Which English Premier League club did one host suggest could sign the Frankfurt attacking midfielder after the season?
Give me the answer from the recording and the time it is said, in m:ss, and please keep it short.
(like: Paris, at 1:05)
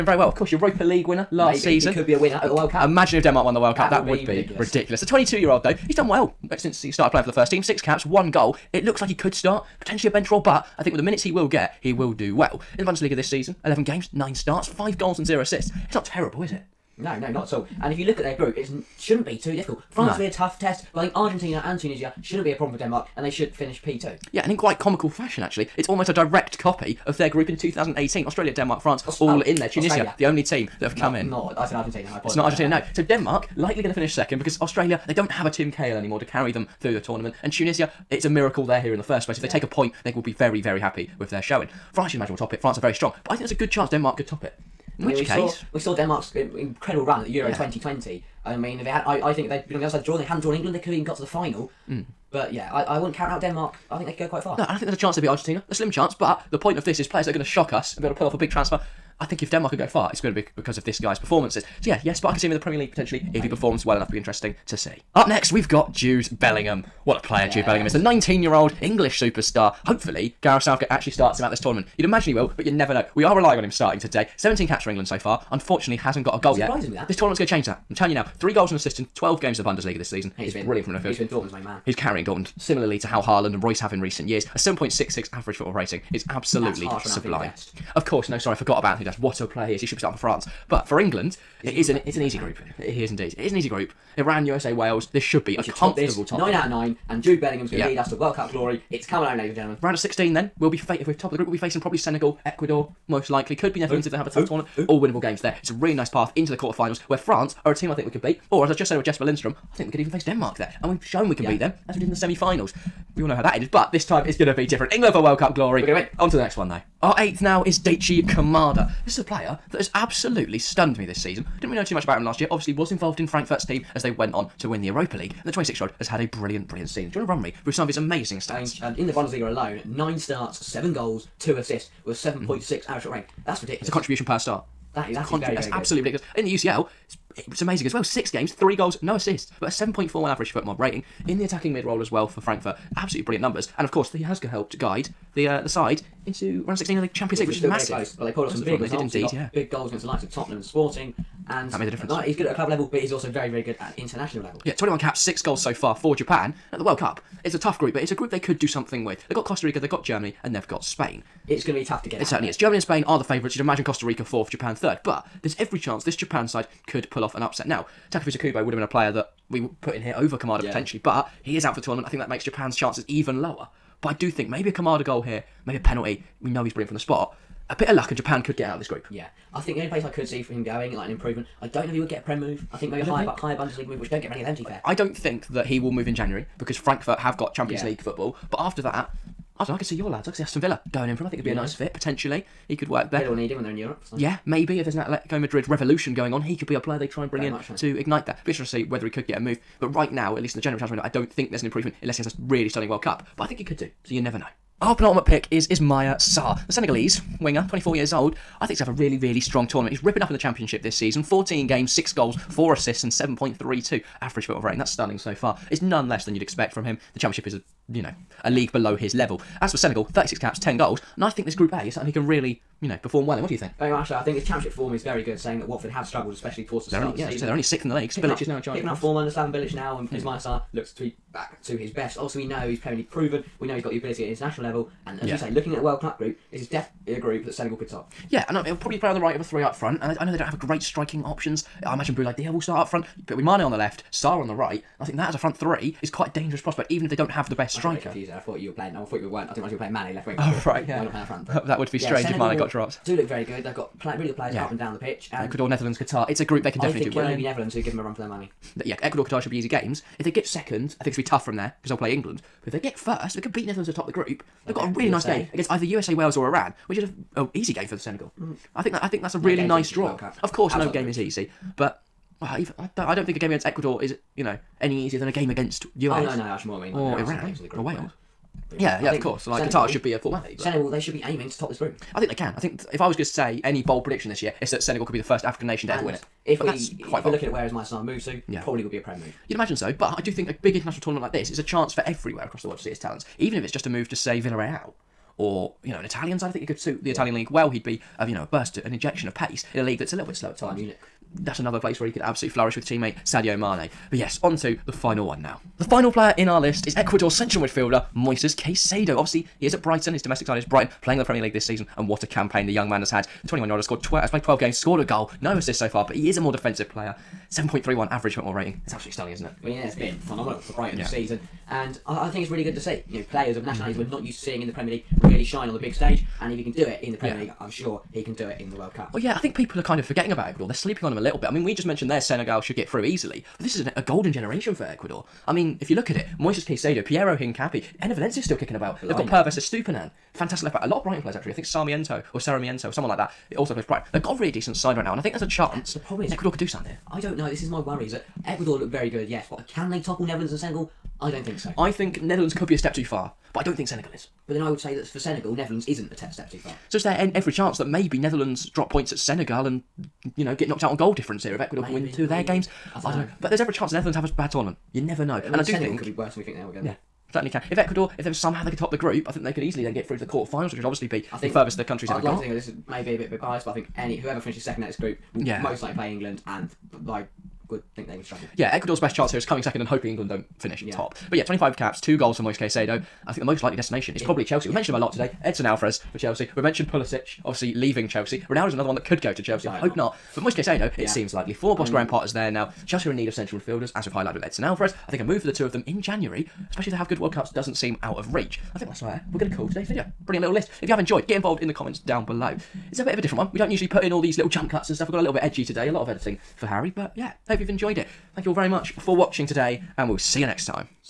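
Aston Villa, at 3:10.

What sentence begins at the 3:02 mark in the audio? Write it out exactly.
I think maybe a higher, think...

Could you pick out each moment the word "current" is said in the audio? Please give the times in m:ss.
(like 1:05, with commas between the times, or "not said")
not said.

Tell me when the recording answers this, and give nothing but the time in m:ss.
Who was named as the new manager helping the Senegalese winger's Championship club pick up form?
3:49.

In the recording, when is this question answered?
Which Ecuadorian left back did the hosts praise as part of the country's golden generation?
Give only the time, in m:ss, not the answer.
5:39.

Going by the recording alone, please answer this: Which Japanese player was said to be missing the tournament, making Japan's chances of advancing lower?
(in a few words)
Takefusa Kubo.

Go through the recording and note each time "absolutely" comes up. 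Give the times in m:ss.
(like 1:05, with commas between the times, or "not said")
1:26, 1:59, 2:15, 2:22, 5:02, 5:18.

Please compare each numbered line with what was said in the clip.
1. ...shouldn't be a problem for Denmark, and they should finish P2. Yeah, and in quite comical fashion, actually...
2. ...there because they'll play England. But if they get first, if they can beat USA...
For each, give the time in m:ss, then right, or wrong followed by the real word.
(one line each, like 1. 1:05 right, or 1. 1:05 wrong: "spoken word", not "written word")
1. 0:22 right
2. 4:21 wrong: "Netherlands", not "USA".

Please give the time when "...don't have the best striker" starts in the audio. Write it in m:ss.
4:07.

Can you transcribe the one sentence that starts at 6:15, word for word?
most likely play England, and like would think they would struggle.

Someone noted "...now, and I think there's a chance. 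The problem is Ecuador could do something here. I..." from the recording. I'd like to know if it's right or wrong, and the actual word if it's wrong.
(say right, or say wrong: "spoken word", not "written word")
right.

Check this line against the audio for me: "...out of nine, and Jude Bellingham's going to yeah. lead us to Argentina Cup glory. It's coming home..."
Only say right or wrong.
wrong.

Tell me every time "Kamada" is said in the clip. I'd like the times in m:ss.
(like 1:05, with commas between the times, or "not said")
1:58, 2:50, 2:54.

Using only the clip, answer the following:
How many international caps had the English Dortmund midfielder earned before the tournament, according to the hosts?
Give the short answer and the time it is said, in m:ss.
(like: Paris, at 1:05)
17, at 1:14.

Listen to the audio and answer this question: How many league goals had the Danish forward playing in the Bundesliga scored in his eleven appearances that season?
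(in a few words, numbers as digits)
5.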